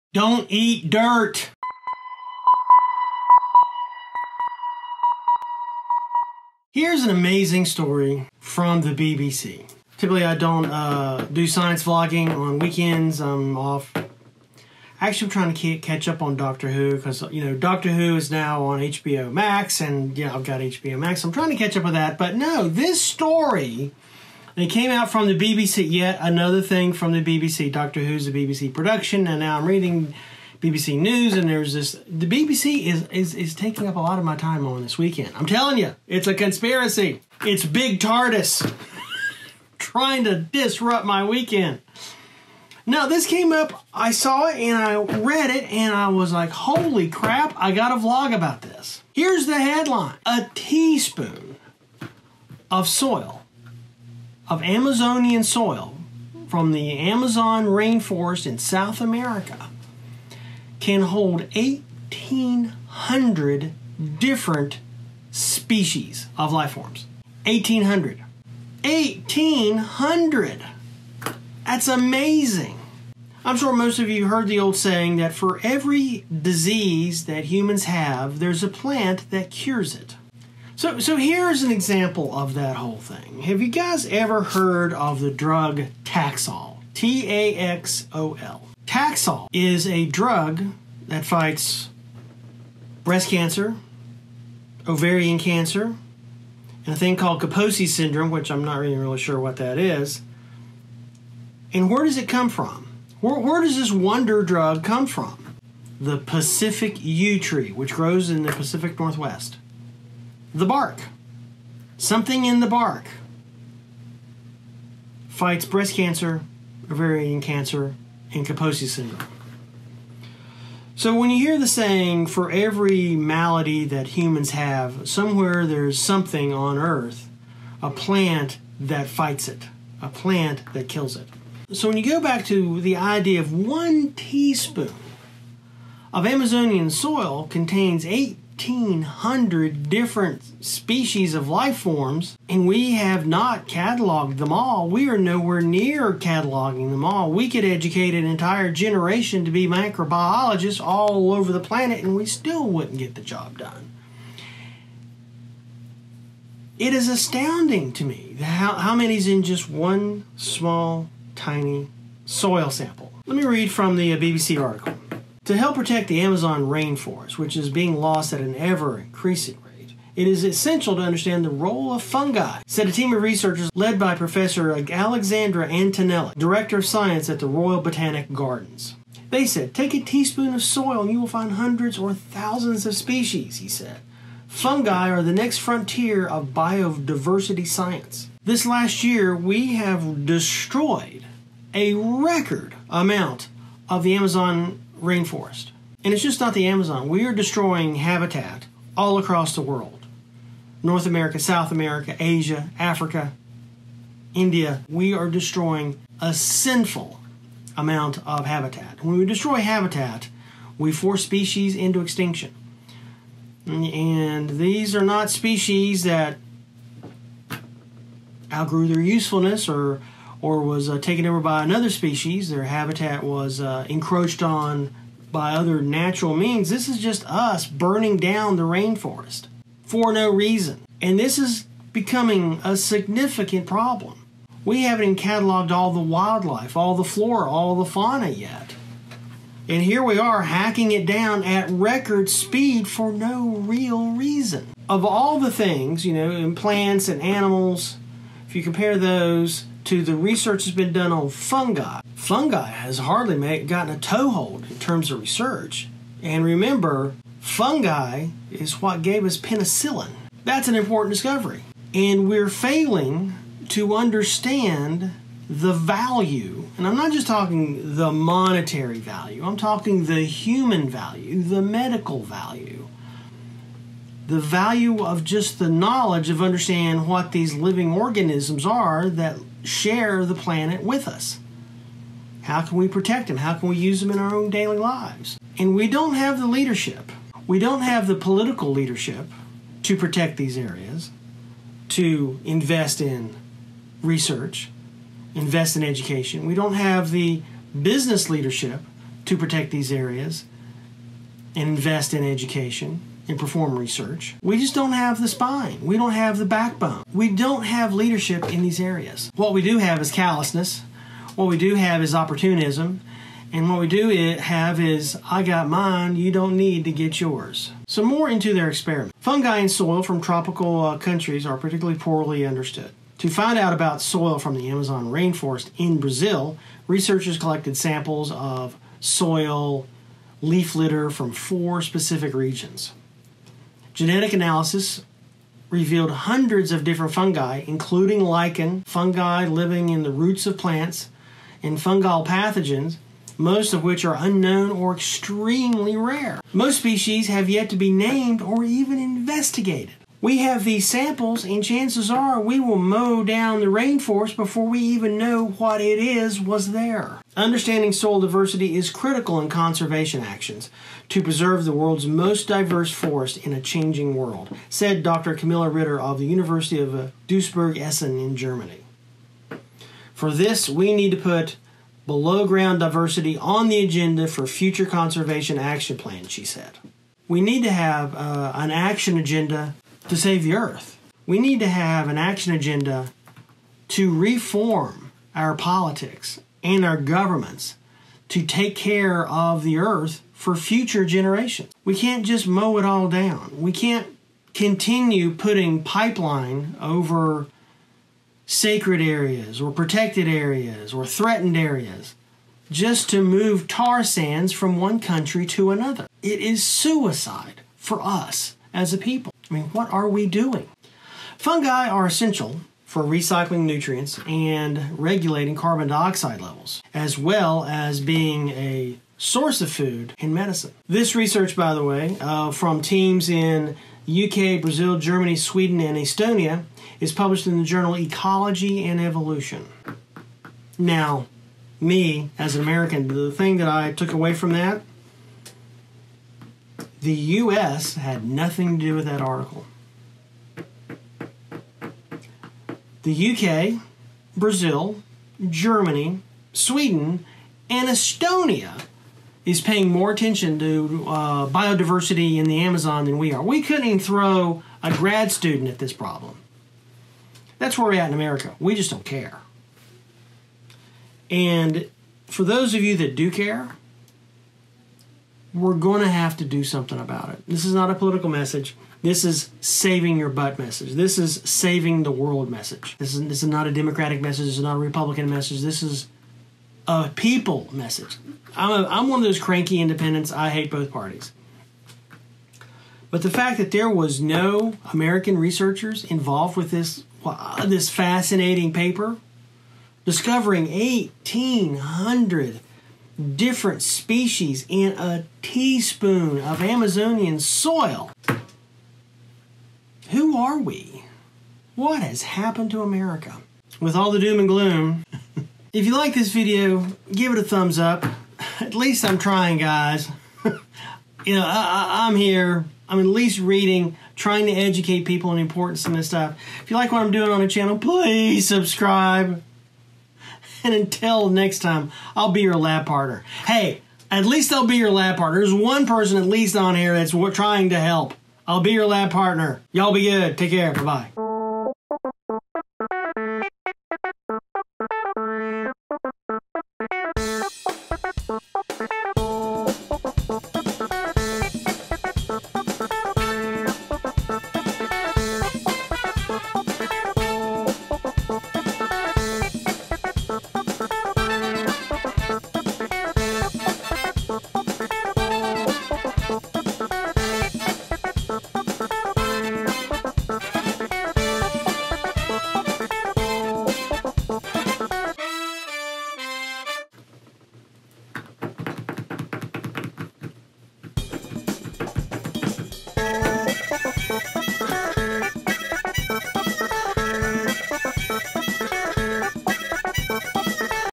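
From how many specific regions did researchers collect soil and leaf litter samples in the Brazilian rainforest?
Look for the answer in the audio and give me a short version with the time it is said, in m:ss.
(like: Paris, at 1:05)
4, at 5:31.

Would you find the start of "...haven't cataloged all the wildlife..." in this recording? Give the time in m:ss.
3:54.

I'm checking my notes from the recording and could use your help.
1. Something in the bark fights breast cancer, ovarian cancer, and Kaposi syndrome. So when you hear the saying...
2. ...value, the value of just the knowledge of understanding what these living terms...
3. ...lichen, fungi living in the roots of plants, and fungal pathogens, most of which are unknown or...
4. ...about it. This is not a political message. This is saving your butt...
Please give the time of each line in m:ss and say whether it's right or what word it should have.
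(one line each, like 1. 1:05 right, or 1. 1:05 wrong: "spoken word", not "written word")
1. 1:51 right
2. 4:32 wrong: "organisms", not "terms"
3. 5:38 right
4. 7:46 right.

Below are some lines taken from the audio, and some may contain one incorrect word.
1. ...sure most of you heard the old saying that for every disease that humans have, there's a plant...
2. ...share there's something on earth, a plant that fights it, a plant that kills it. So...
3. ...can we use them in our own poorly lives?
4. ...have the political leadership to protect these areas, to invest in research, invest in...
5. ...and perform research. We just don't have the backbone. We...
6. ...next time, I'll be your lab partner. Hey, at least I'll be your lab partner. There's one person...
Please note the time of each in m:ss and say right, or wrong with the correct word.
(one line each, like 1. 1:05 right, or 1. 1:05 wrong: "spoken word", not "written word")
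1. 1:13 right
2. 2:05 wrong: "somewhere", not "share"
3. 4:43 wrong: "daily", not "poorly"
4. 4:47 right
5. 5:03 wrong: "spine", not "backbone"
6. 8:41 right.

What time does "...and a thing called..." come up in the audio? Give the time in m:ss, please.
1:36.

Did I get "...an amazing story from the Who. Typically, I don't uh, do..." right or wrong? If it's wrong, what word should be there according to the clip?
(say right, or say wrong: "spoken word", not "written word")
wrong: "BBC", not "Who".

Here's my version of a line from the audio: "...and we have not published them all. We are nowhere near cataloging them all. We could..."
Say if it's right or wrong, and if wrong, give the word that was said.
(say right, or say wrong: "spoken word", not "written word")
wrong: "cataloged", not "published".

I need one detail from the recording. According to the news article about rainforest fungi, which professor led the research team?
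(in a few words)
Alexandra Antonelli.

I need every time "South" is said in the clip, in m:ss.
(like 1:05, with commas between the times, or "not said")
0:58, 3:21.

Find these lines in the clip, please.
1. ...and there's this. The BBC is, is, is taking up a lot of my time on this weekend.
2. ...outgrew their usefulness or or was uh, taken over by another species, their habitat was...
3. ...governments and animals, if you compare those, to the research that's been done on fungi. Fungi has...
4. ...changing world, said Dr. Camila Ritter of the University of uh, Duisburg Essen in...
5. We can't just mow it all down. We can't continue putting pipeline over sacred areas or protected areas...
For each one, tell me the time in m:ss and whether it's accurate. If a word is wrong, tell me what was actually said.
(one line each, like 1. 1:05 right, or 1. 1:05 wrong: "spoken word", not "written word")
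1. 0:31 right
2. 3:38 right
3. 4:06 wrong: "plants", not "governments"
4. 6:03 right
5. 6:31 right.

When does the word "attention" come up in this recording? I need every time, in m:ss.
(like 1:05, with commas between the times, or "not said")
7:30.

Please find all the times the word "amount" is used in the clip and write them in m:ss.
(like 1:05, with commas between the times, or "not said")
3:12, 3:27.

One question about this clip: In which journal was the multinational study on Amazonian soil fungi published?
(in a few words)
Ecology and Evolution.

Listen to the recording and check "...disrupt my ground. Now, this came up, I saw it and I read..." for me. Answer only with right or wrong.
wrong.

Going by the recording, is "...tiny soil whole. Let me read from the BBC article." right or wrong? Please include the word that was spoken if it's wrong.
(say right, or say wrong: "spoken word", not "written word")
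wrong: "sample", not "whole".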